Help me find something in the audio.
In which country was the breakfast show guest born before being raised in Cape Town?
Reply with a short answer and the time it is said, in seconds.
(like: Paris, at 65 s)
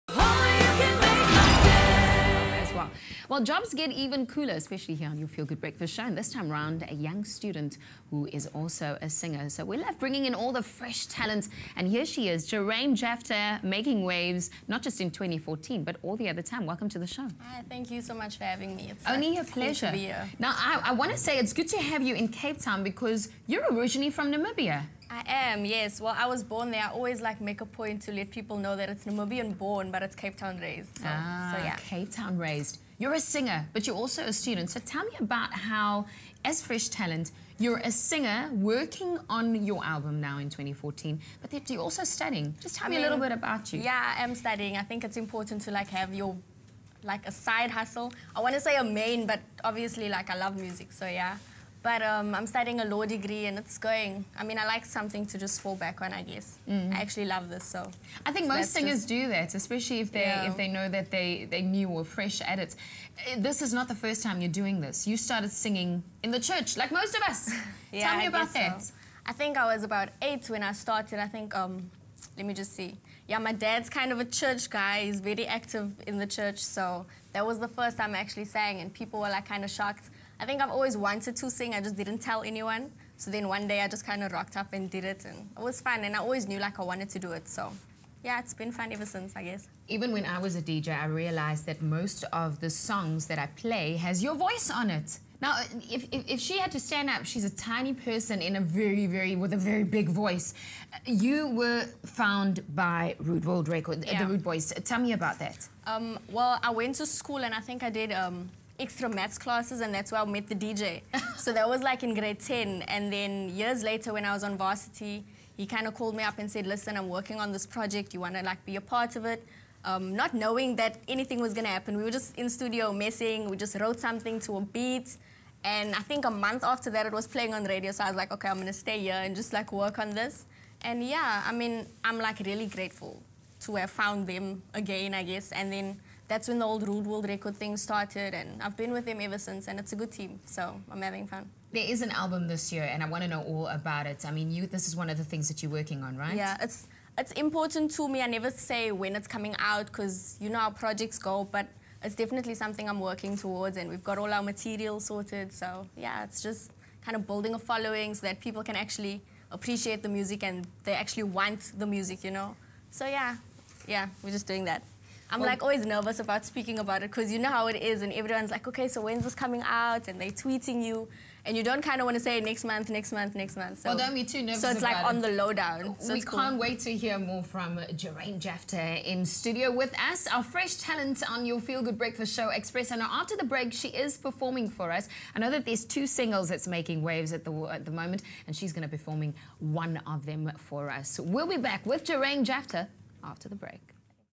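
Namibia, at 24 s.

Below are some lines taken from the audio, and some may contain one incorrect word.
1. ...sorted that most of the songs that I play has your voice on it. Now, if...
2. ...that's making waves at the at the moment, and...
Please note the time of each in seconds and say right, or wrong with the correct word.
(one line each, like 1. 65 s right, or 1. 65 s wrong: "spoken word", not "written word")
1. 91 s wrong: "realized", not "sorted"
2. 186 s right.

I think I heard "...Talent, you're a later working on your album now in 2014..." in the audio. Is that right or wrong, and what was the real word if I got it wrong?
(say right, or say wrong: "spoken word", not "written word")
wrong: "singer", not "later".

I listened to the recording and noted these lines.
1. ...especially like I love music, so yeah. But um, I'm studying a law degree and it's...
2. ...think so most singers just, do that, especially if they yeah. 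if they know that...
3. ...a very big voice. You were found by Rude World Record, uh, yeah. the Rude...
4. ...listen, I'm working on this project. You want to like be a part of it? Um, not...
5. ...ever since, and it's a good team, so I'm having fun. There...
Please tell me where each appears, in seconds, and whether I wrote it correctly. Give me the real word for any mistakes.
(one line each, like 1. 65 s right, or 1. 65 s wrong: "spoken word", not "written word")
1. 49 s wrong: "obviously", not "especially"
2. 58 s right
3. 99 s right
4. 116 s right
5. 139 s right.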